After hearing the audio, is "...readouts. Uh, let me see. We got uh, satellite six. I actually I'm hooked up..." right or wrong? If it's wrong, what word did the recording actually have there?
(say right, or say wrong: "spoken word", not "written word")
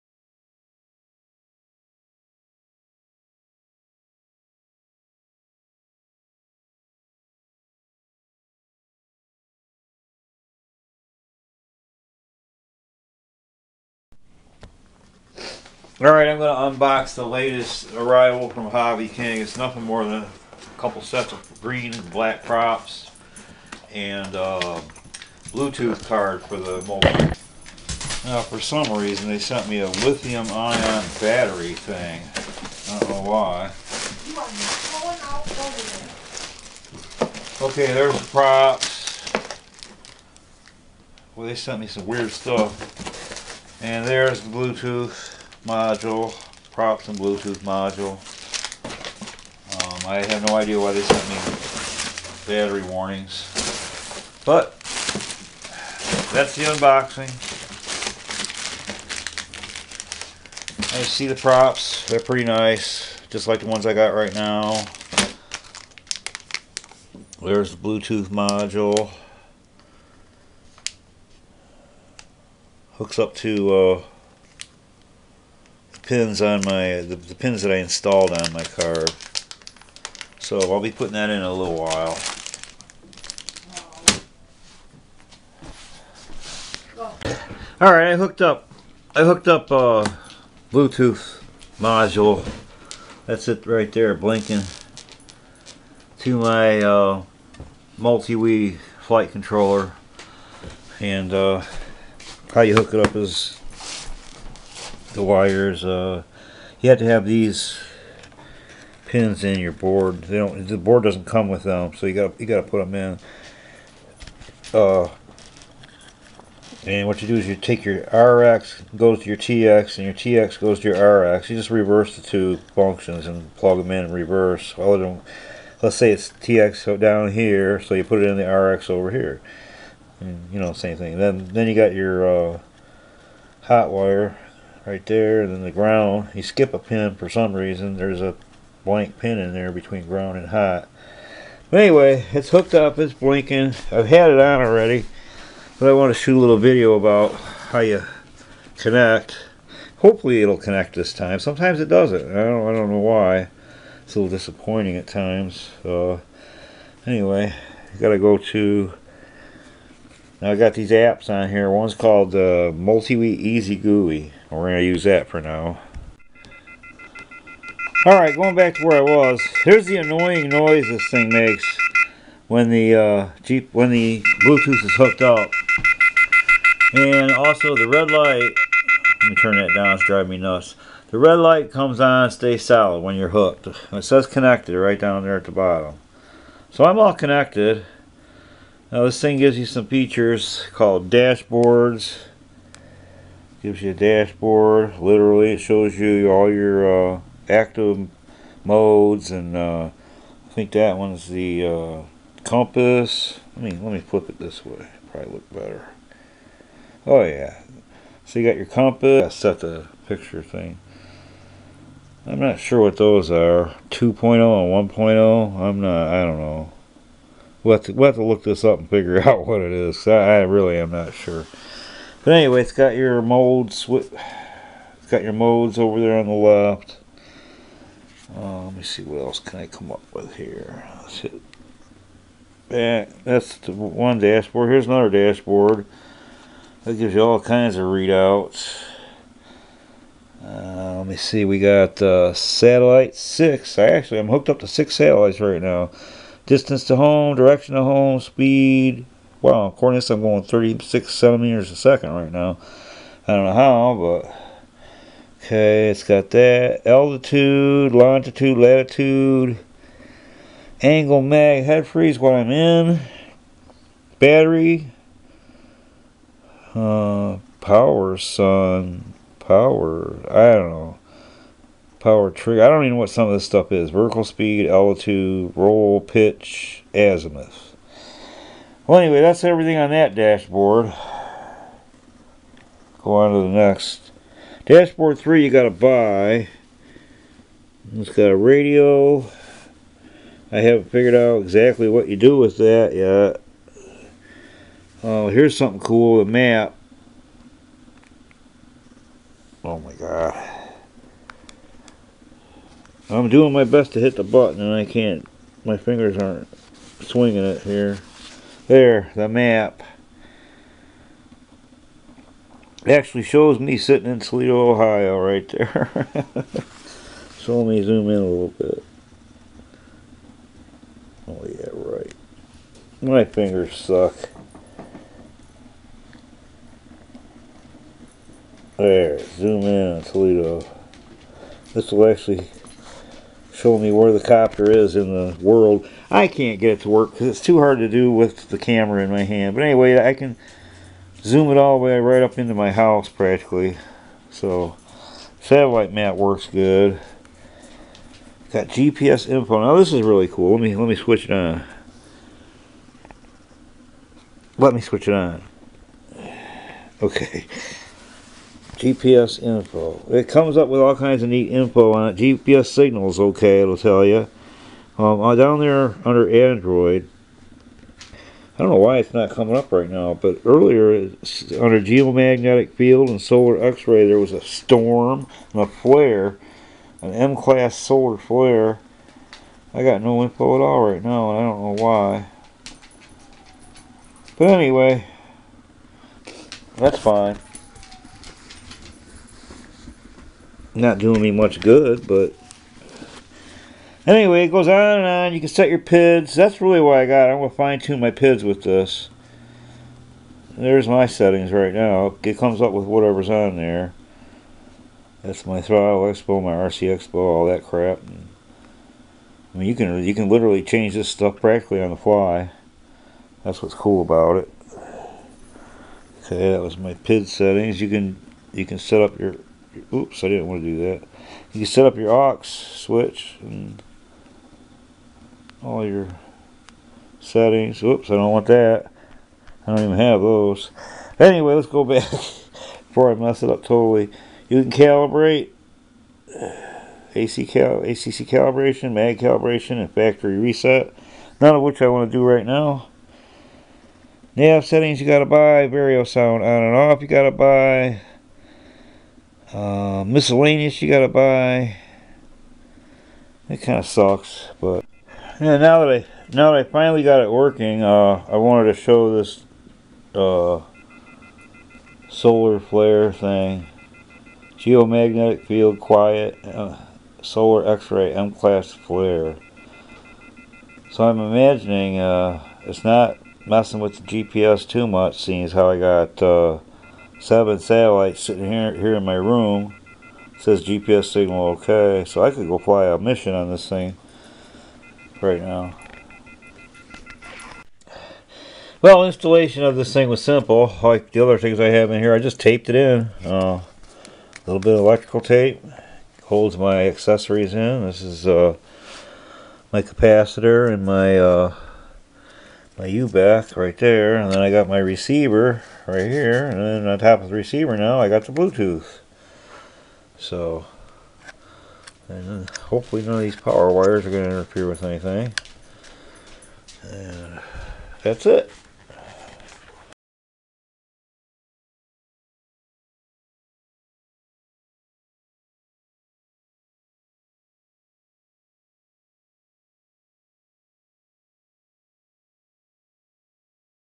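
right.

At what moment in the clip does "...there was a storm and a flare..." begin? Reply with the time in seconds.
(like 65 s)
374 s.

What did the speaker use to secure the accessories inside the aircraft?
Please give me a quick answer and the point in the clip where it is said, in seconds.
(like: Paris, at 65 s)
electrical tape, at 494 s.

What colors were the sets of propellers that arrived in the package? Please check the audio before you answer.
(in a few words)
green and black.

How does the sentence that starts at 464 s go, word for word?
Geomagnetic field quiet uh, solar X-ray M-class flare.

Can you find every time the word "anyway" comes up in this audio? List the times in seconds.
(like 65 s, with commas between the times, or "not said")
141 s, 157 s, 222 s, 278 s, 339 s, 384 s, 394 s, 431 s.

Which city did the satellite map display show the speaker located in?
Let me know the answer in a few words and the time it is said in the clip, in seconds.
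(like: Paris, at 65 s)
Toledo, Ohio, at 314 s.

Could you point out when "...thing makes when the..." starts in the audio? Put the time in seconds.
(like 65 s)
171 s.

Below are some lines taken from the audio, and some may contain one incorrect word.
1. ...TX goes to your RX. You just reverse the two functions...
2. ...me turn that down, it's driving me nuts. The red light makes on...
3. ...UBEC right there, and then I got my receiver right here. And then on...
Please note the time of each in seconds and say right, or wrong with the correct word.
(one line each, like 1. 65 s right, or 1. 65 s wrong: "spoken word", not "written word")
1. 120 s right
2. 179 s wrong: "comes", not "makes"
3. 502 s right.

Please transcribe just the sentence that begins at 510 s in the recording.
So, and hopefully none of these power wires are going to interfere with anything.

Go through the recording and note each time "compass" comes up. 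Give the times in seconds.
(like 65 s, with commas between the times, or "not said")
202 s, 208 s.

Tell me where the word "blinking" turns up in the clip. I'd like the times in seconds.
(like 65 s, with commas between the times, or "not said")
94 s, 143 s.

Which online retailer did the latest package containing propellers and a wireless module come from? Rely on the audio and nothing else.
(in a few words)
Hobby King.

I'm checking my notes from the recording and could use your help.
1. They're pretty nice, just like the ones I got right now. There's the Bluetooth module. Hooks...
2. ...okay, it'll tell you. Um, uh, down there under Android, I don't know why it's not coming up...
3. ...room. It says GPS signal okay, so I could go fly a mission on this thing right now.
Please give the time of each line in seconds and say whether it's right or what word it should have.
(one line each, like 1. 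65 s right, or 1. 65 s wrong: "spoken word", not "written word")
1. 62 s right
2. 363 s right
3. 479 s right.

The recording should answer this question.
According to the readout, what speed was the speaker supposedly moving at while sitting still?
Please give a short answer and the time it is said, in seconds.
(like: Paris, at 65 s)
36 centimeters a second, at 250 s.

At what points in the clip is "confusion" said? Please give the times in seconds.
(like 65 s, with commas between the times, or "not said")
not said.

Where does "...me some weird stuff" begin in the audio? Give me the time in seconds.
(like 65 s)
41 s.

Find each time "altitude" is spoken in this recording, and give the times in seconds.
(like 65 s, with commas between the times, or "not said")
256 s, 274 s.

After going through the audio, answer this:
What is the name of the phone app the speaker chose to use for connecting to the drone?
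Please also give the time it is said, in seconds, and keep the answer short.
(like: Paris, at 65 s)
MultiWii Easy GUI, at 162 s.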